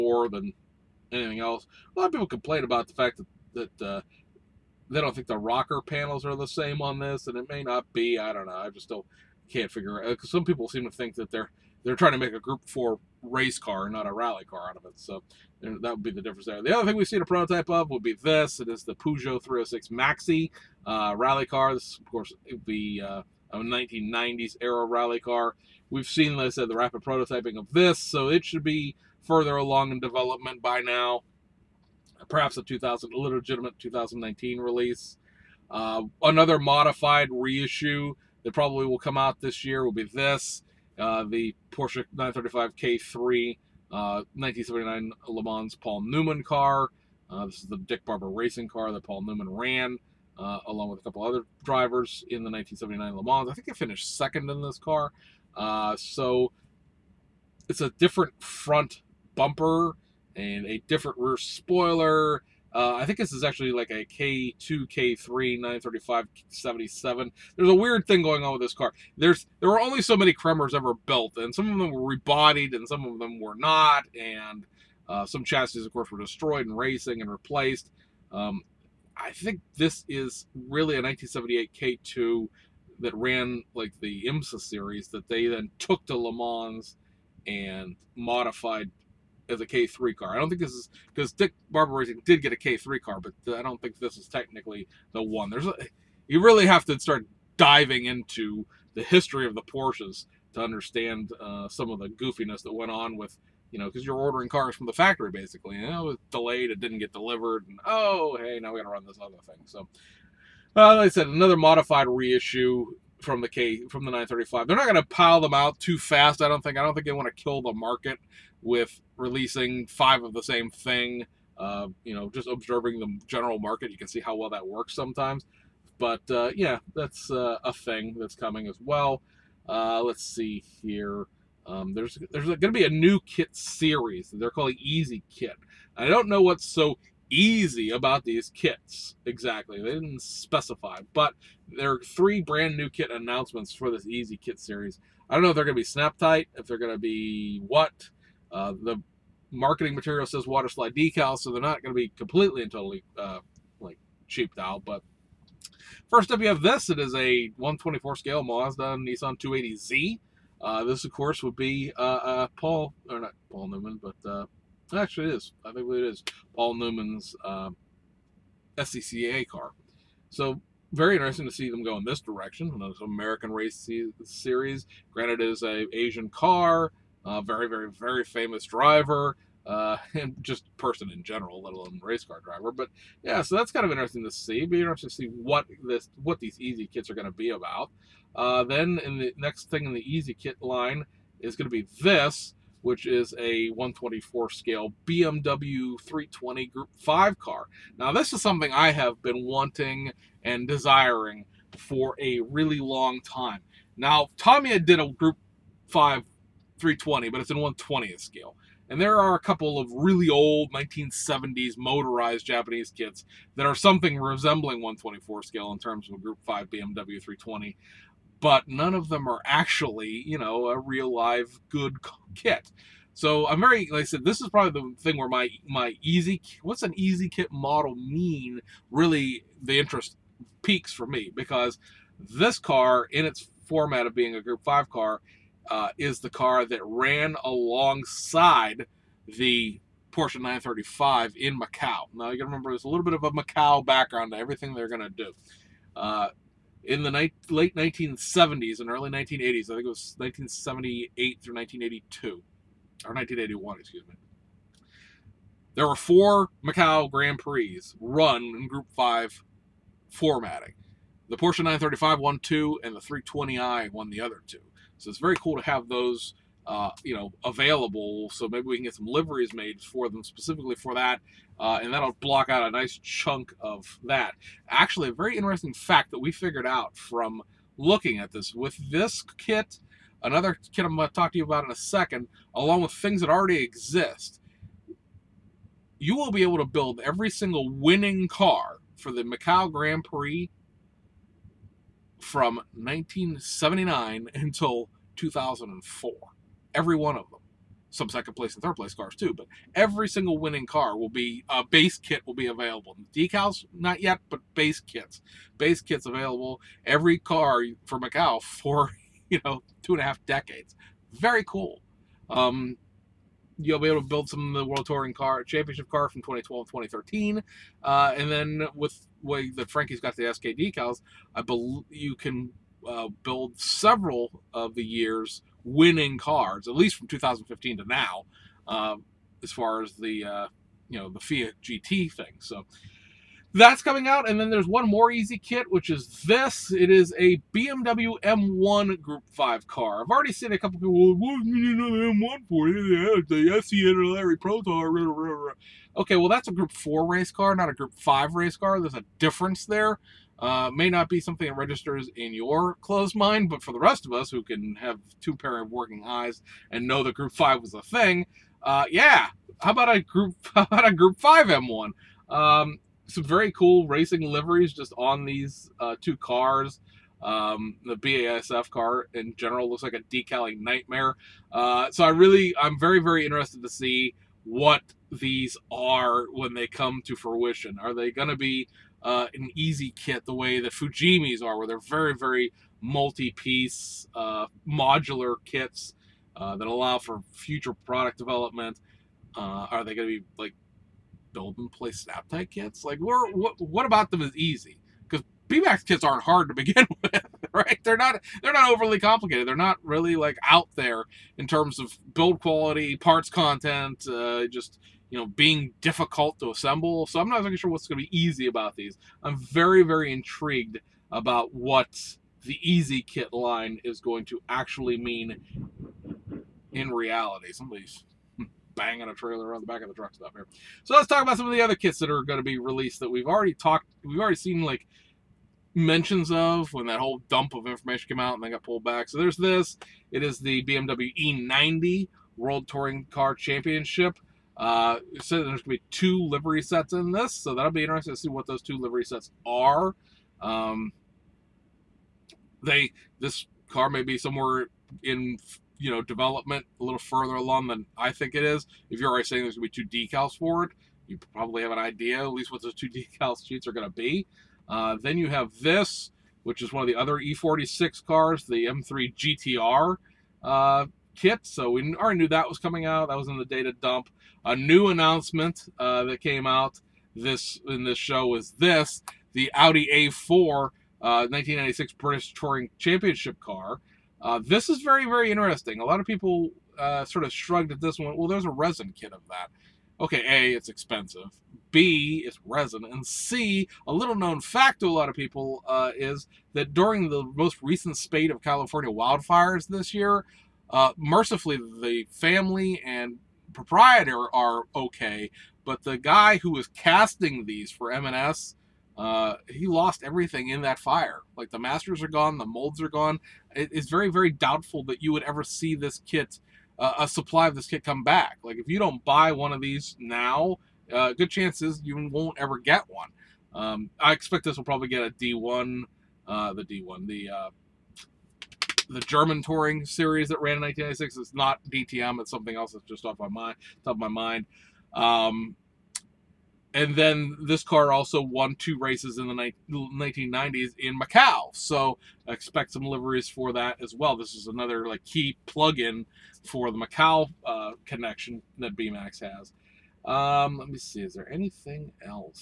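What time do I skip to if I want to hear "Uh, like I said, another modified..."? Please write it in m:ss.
1:50.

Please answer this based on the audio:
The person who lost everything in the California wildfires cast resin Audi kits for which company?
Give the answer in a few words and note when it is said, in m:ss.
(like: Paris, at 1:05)
M&S, at 8:17.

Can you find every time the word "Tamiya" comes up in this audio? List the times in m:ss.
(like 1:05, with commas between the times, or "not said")
3:24.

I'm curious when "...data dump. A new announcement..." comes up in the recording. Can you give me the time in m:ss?
7:43.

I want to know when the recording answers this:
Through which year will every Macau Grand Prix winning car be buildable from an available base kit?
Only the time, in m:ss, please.
4:55.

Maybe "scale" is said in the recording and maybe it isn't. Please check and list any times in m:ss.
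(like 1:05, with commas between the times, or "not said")
2:38, 3:14, 3:28, 3:35.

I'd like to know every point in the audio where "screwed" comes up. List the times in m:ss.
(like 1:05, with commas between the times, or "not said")
not said.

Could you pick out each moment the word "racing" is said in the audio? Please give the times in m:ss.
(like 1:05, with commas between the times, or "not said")
0:48, 1:16, 1:31, 6:03.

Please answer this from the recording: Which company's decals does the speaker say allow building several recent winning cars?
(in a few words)
SKD.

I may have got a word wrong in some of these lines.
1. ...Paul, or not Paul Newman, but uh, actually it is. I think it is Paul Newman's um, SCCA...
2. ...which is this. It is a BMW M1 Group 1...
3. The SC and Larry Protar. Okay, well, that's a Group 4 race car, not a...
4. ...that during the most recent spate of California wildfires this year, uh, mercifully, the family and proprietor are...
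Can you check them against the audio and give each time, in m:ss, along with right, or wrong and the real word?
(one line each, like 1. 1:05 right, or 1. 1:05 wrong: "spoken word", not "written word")
1. 2:42 right
2. 5:35 wrong: "5", not "1"
3. 5:43 right
4. 8:06 right.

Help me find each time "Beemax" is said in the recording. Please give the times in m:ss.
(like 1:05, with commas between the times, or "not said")
6:35, 8:58.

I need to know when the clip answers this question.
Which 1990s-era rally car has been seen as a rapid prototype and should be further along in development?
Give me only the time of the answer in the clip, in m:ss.
0:18.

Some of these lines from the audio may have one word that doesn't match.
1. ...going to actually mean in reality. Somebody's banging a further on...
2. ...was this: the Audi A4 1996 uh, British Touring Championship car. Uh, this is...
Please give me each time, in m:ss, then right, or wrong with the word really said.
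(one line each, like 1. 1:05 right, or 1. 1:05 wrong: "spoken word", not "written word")
1. 6:53 wrong: "trailer", not "further"
2. 7:48 right.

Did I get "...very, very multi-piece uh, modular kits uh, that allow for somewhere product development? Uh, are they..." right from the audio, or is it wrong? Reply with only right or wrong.
wrong.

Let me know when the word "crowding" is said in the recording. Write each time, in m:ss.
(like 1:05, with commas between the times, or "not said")
not said.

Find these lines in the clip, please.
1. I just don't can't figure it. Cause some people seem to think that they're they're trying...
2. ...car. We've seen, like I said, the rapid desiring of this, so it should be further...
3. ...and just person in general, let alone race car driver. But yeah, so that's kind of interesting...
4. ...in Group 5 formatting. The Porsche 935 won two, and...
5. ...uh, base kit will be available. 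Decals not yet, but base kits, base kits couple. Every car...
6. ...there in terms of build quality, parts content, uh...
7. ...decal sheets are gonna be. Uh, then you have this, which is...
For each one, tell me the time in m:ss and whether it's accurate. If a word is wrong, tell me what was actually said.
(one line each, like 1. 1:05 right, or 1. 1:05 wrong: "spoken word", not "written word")
1. 0:08 right
2. 0:25 wrong: "prototyping", not "desiring"
3. 3:00 right
4. 4:18 right
5. 5:01 wrong: "available", not "couple"
6. 6:40 right
7. 7:32 right.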